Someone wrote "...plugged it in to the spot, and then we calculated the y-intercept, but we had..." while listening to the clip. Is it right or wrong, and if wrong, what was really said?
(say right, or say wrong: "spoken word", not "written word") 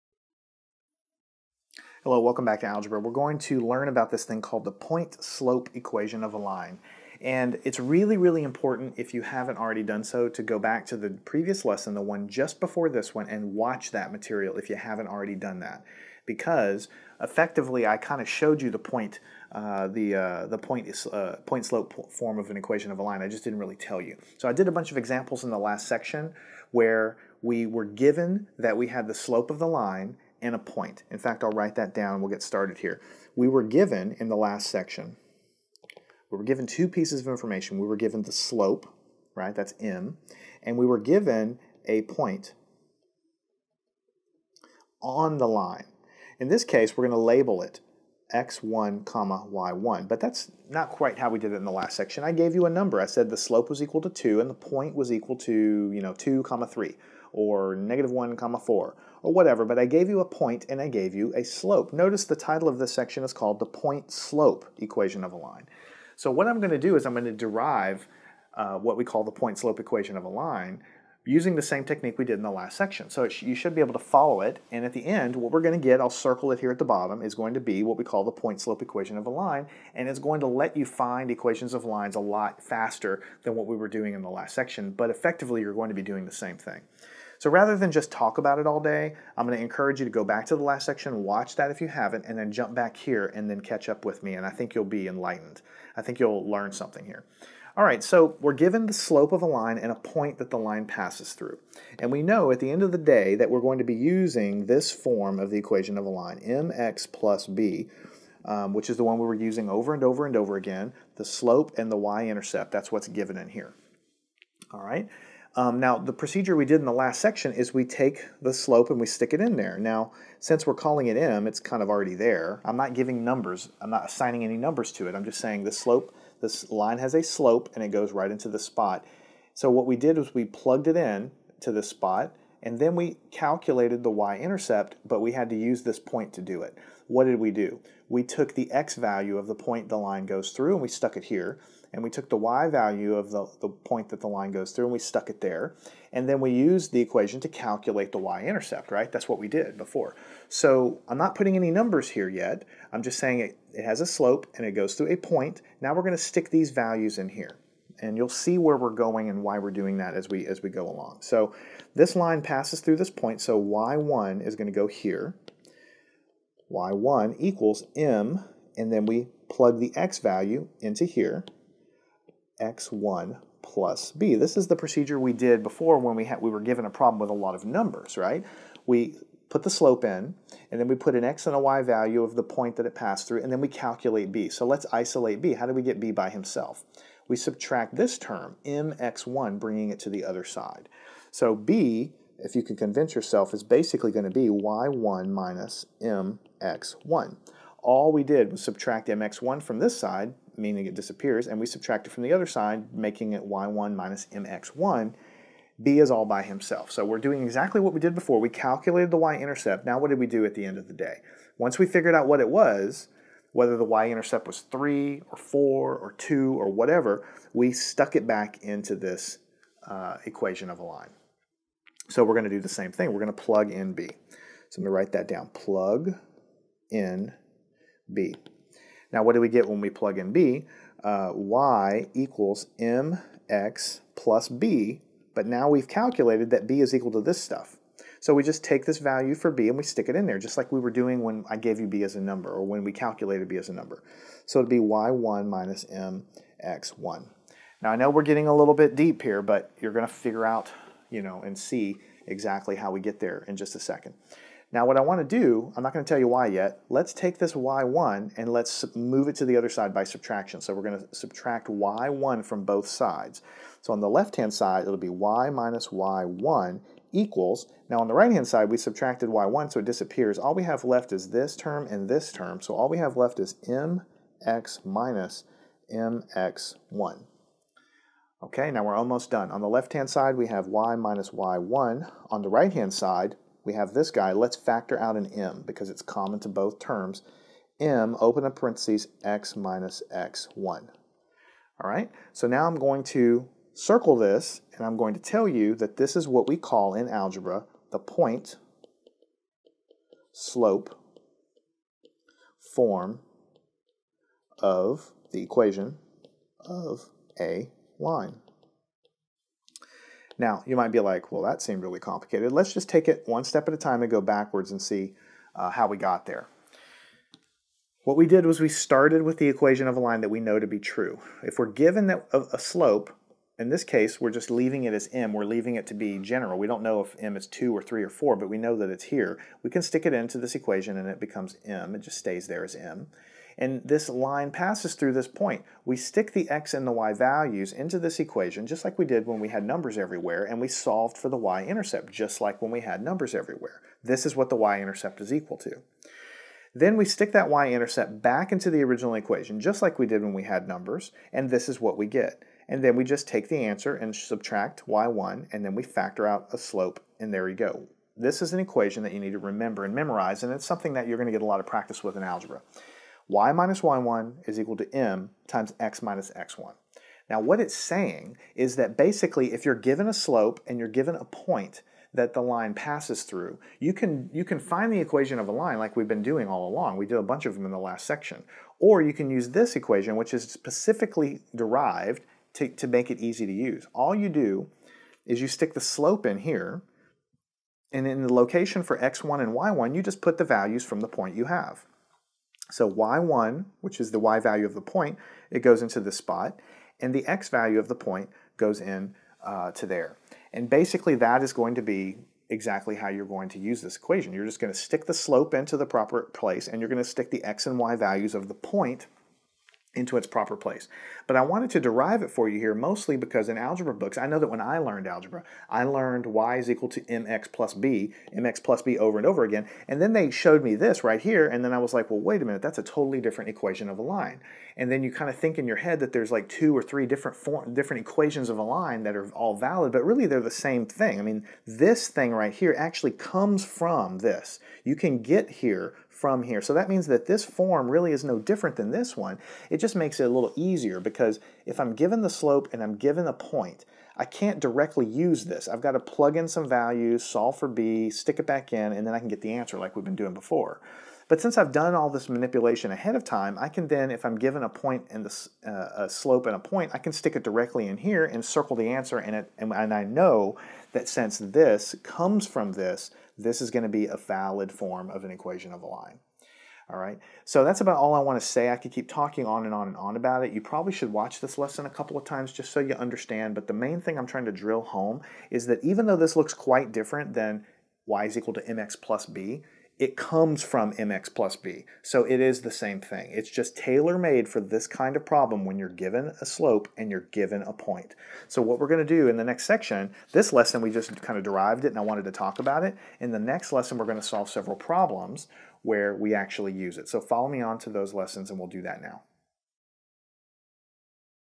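right.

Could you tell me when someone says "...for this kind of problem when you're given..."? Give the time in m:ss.
8:04.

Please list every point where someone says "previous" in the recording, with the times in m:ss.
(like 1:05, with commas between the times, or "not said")
0:11.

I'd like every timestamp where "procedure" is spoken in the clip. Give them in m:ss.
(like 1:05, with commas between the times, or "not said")
1:56, 2:54.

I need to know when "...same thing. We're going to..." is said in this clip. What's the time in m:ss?
3:42.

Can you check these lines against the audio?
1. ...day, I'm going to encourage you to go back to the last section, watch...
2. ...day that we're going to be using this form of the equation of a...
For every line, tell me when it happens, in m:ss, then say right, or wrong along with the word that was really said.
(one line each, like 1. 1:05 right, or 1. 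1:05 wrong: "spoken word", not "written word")
1. 1:28 right
2. 1:42 right.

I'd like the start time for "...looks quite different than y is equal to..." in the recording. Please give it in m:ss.
7:56.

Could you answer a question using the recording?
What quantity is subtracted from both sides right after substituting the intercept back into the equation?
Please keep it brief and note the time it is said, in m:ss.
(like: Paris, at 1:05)
y1, at 4:21.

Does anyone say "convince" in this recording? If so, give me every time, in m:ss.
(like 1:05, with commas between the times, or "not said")
3:12.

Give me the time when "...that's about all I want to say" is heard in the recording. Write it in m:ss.
7:47.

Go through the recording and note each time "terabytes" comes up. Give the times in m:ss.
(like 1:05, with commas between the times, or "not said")
not said.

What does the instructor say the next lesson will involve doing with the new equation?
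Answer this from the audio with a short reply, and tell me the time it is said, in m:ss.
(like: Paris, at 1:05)
solve several problems, at 8:14.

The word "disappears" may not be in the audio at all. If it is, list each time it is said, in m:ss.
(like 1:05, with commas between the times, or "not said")
3:20, 4:29.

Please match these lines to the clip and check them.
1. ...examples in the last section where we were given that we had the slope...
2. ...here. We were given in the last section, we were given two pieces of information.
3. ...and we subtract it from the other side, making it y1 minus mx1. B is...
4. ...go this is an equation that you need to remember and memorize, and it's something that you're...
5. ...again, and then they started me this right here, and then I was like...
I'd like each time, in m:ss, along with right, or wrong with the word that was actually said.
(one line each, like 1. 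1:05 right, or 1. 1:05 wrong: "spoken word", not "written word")
1. 0:24 right
2. 0:32 right
3. 3:21 right
4. 5:57 right
5. 6:59 wrong: "showed", not "started".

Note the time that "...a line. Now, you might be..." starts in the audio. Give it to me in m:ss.
5:07.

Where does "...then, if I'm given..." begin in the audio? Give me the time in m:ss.
7:33.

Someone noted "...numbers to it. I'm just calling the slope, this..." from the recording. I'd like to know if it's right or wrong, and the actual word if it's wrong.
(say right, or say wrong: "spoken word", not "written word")
wrong: "saying", not "calling".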